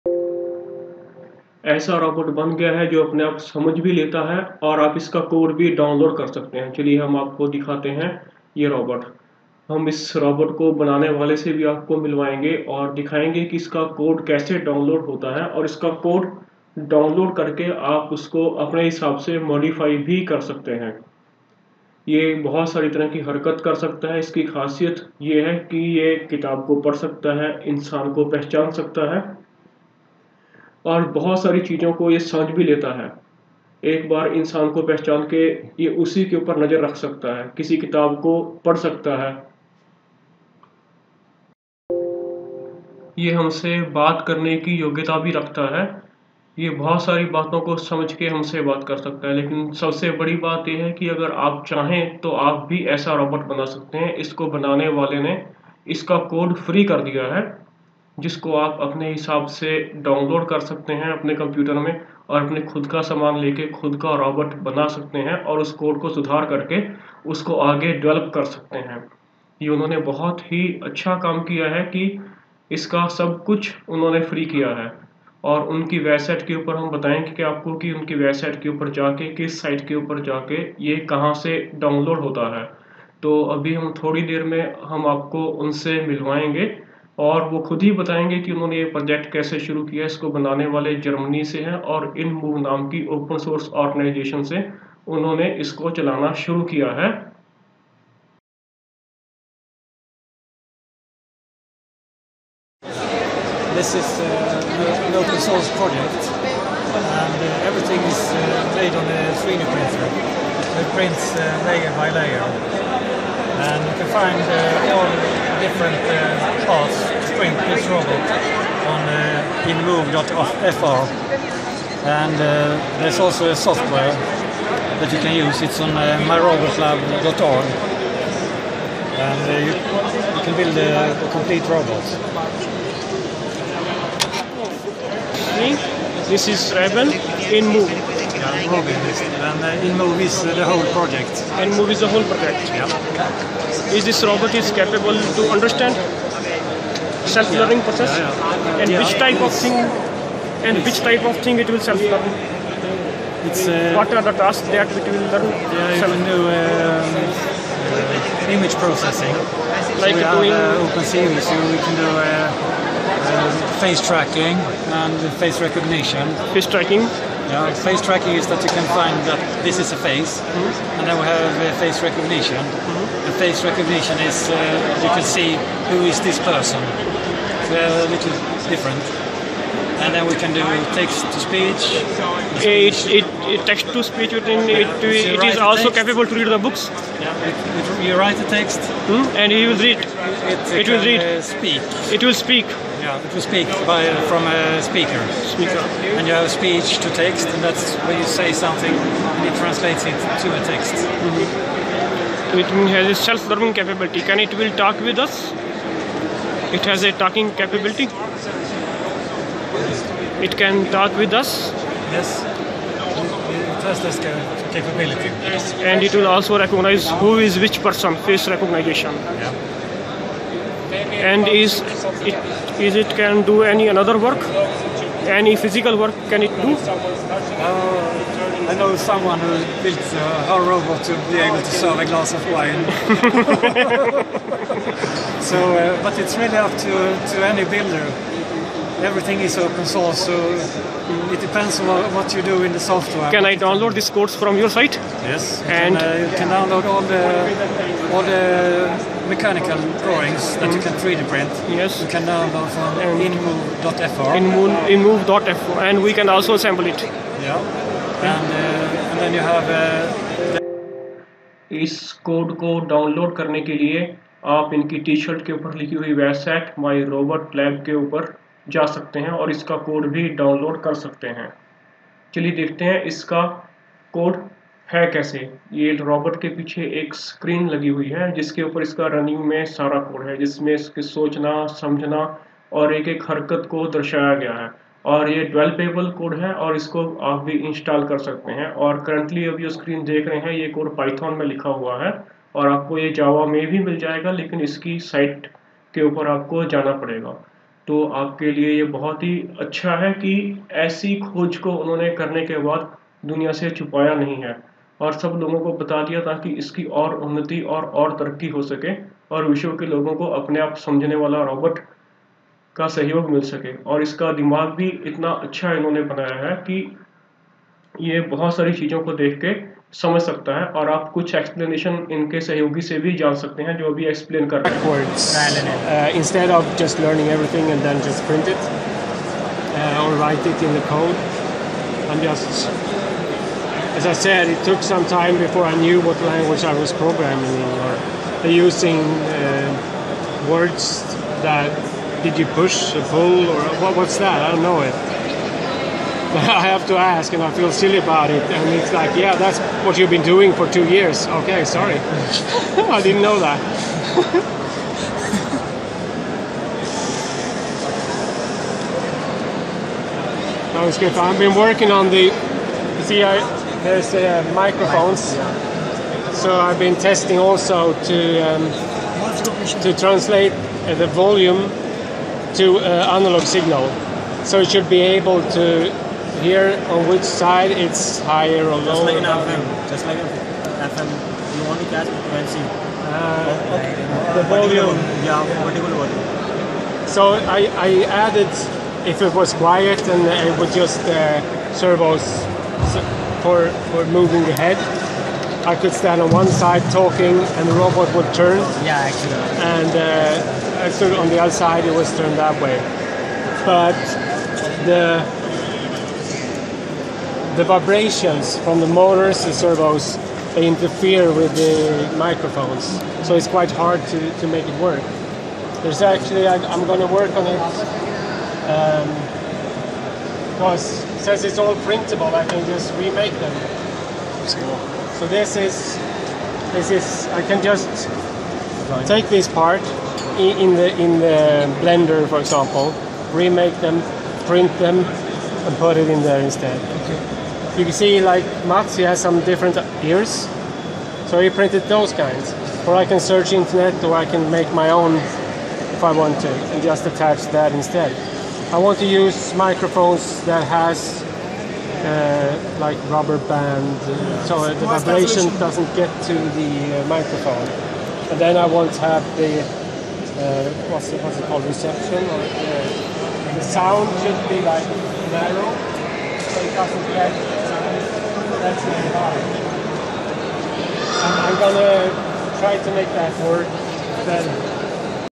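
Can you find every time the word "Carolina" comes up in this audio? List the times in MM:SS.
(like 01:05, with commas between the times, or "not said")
not said.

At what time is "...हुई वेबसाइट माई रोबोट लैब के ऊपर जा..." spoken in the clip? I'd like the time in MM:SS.
04:25.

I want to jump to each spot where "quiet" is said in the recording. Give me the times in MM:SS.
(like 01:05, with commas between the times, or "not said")
06:29.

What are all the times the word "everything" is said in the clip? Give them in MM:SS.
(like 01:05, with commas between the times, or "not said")
01:47, 03:59.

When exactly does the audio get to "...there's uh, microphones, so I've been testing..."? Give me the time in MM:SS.
06:03.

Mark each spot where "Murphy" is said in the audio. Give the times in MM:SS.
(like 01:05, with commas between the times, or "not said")
not said.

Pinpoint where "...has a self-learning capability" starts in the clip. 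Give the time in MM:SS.
03:22.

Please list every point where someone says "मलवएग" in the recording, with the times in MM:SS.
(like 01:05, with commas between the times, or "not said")
00:12, 01:26.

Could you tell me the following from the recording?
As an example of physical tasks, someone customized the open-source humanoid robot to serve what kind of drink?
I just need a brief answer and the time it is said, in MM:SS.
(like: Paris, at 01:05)
Wine, at 03:52.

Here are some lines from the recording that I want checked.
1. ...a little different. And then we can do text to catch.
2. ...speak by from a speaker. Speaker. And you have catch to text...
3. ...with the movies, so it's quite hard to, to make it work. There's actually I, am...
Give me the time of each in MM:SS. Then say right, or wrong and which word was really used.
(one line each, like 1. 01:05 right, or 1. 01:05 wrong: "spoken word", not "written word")
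1. 02:57 wrong: "speech", not "catch"
2. 03:13 wrong: "speech", not "catch"
3. 06:51 wrong: "microphones", not "movies".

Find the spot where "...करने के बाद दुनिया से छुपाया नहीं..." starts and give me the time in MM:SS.
05:02.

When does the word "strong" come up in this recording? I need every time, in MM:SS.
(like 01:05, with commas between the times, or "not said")
not said.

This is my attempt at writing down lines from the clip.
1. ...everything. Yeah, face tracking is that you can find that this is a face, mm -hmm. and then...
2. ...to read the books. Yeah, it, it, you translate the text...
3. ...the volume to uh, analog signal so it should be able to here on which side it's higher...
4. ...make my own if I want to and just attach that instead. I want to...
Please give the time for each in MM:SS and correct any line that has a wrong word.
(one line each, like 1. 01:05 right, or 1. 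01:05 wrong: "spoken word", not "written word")
1. 02:46 wrong: "tracking", not "everything"
2. 03:06 wrong: "write", not "translate"
3. 06:10 right
4. 07:24 right.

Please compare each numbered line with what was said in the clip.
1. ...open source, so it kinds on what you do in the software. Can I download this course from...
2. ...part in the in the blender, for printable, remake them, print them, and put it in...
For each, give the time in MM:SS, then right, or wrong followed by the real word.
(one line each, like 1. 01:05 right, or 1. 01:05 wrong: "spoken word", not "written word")
1. 03:59 wrong: "depends", not "kinds"
2. 07:09 wrong: "example", not "printable".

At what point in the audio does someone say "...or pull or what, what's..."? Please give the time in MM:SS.
05:42.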